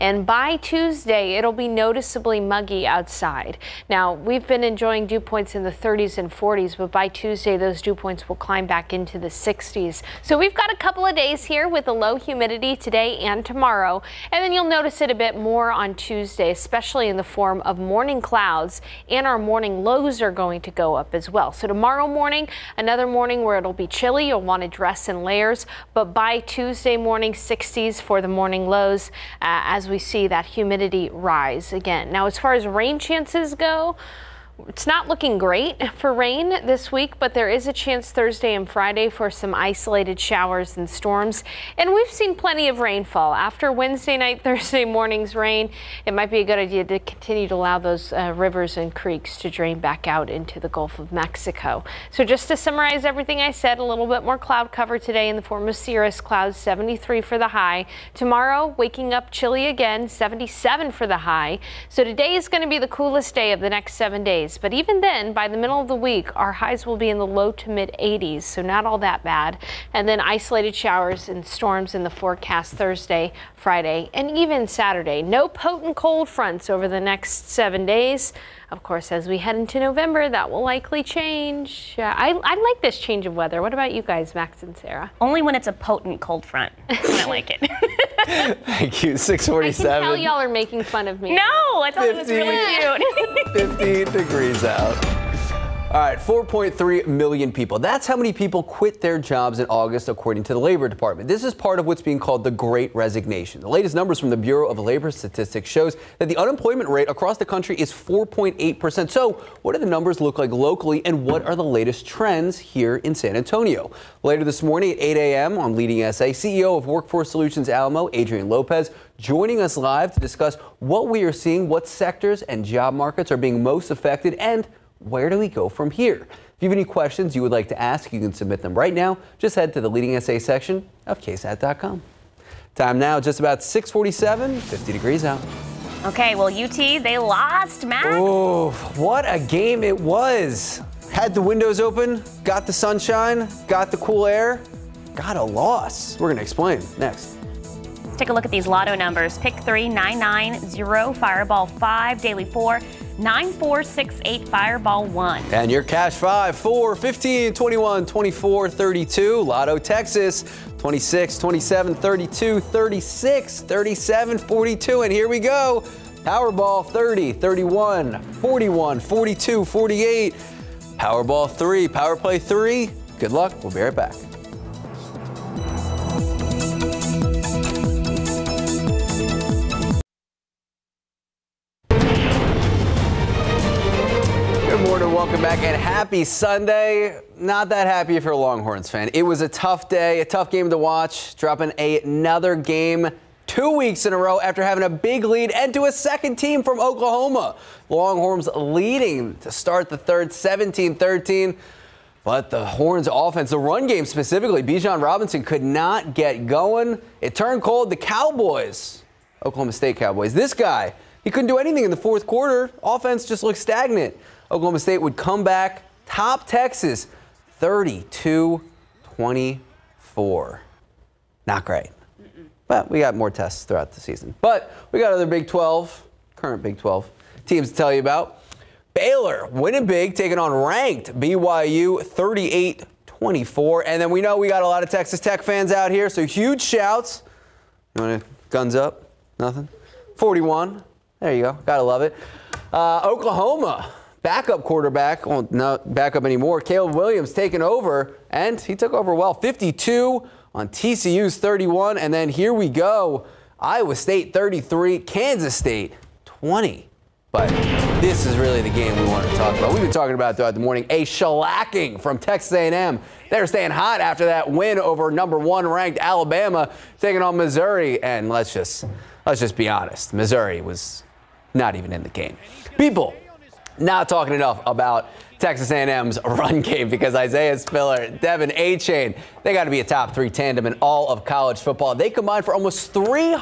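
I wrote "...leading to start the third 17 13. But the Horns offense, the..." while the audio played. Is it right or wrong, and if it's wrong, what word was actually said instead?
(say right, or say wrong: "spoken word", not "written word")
right.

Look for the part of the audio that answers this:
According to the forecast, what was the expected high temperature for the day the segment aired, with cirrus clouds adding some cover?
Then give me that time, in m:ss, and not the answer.
0:56.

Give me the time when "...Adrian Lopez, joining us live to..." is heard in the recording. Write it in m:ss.
1:58.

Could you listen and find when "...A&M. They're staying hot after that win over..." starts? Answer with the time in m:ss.
4:22.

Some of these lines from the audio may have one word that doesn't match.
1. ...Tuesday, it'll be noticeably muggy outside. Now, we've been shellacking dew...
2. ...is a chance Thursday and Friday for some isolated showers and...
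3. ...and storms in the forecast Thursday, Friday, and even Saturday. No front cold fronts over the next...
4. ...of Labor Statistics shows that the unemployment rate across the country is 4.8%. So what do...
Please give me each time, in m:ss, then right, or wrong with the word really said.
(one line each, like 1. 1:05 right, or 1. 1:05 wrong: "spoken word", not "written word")
1. 0:00 wrong: "enjoying", not "shellacking"
2. 0:37 right
3. 1:11 wrong: "potent", not "front"
4. 1:44 right.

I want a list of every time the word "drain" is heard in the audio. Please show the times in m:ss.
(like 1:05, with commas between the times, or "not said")
0:49.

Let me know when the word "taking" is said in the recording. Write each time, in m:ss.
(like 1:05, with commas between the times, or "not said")
3:50, 4:07, 4:26.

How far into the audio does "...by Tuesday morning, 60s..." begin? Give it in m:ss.
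0:26.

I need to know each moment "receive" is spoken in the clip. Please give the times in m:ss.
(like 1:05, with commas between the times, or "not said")
not said.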